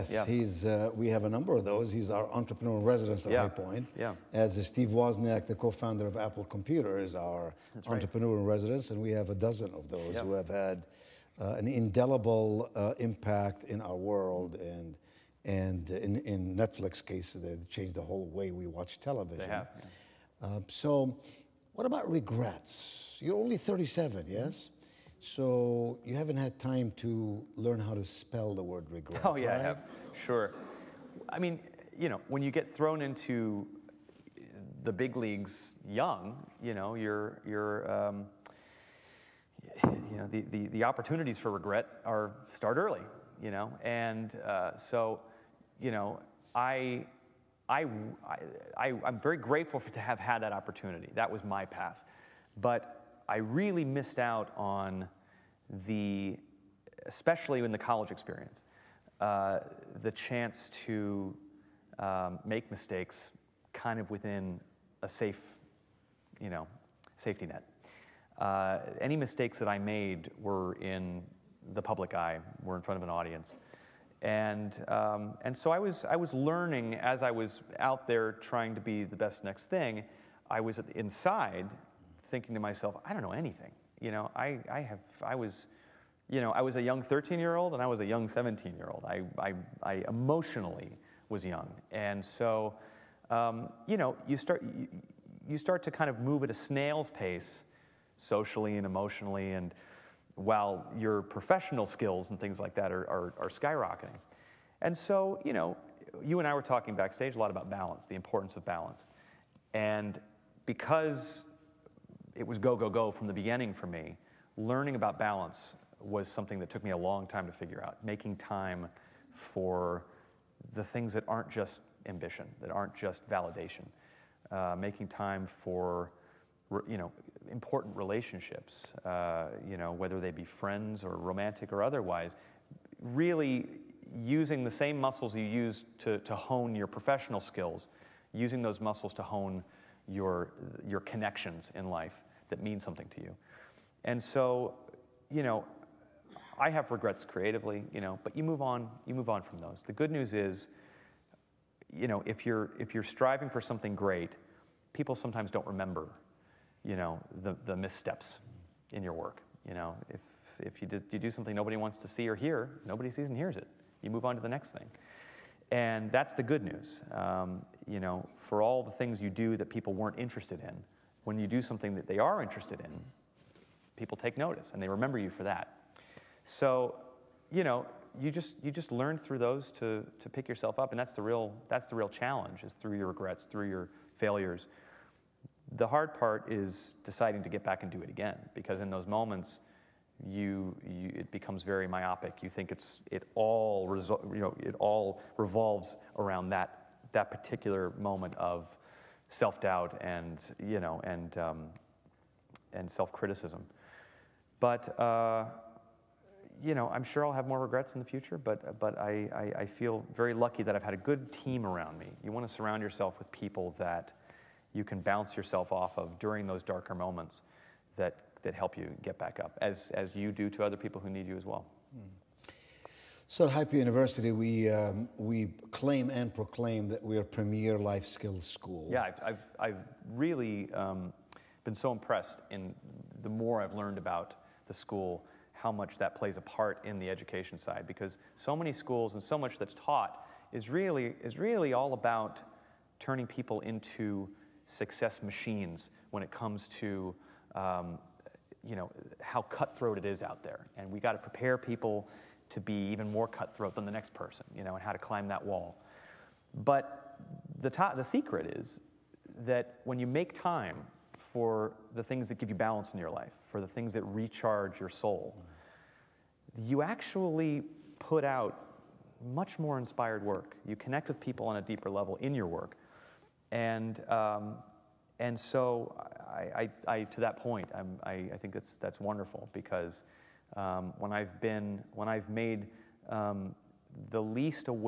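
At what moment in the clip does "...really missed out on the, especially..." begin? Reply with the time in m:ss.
0:53.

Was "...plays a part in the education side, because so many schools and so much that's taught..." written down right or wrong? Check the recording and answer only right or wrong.
right.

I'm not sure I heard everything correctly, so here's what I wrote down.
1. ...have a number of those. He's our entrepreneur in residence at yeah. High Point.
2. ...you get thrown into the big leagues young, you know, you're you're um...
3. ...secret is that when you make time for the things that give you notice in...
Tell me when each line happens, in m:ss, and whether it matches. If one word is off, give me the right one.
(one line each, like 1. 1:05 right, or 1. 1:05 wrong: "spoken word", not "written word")
1. 0:01 right
2. 0:32 right
3. 4:18 wrong: "balance", not "notice".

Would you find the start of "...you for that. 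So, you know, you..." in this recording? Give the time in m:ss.
2:55.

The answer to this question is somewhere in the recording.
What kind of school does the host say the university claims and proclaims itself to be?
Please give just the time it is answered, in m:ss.
3:47.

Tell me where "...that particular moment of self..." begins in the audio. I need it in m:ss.
3:17.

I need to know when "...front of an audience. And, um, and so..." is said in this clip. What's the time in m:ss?
1:12.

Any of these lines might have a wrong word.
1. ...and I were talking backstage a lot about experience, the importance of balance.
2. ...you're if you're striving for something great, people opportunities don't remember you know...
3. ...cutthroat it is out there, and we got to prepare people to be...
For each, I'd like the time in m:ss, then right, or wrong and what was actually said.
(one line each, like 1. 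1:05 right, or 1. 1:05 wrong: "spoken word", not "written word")
1. 1:46 wrong: "balance", not "experience"
2. 2:32 wrong: "sometimes", not "opportunities"
3. 4:09 right.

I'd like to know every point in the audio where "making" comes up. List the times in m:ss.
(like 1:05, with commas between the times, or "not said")
1:58, 2:04.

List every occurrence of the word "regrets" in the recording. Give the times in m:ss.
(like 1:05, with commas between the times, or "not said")
0:22, 0:28, 0:41, 2:26, 3:03, 3:27.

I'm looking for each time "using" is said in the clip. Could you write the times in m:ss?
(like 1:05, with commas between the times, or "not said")
2:14, 2:18.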